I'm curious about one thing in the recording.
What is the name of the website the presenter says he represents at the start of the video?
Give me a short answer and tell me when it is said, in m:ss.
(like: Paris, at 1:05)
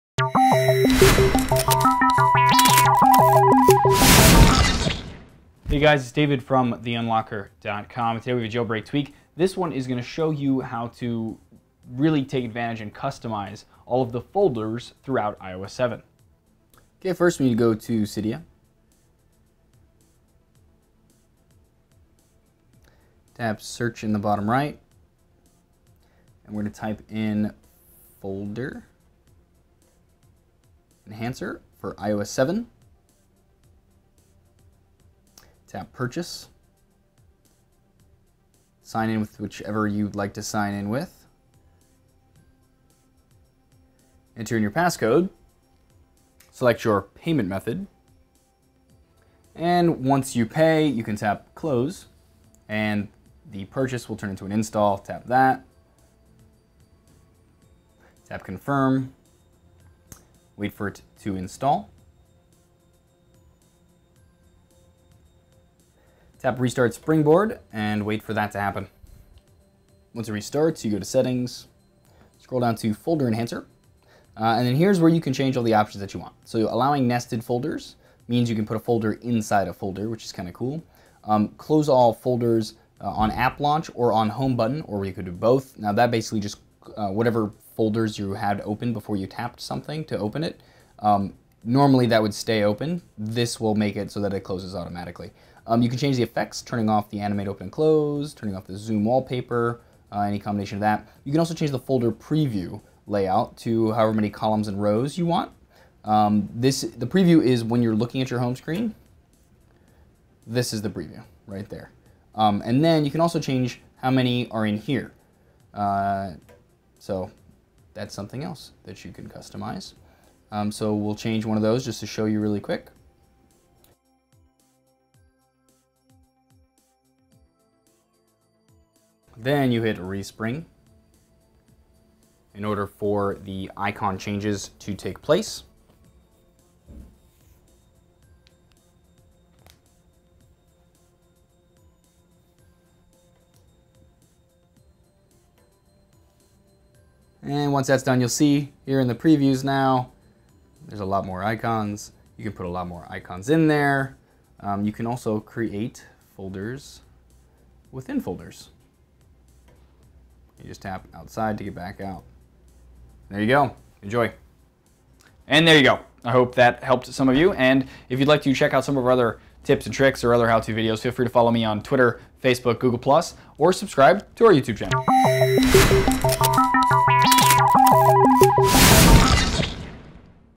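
theunlockr.com, at 0:06.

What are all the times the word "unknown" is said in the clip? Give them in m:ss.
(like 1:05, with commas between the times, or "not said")
not said.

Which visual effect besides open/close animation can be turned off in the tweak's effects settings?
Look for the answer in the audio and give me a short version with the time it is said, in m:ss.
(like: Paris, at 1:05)
Zoom wallpaper, at 1:38.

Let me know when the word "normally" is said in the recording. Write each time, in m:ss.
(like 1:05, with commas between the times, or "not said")
1:31.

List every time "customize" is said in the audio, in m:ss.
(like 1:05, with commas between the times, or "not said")
0:12, 1:59.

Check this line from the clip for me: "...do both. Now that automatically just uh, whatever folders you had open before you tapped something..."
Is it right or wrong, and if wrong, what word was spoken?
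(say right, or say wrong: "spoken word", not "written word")
wrong: "basically", not "automatically".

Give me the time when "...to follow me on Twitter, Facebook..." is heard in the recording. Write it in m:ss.
2:51.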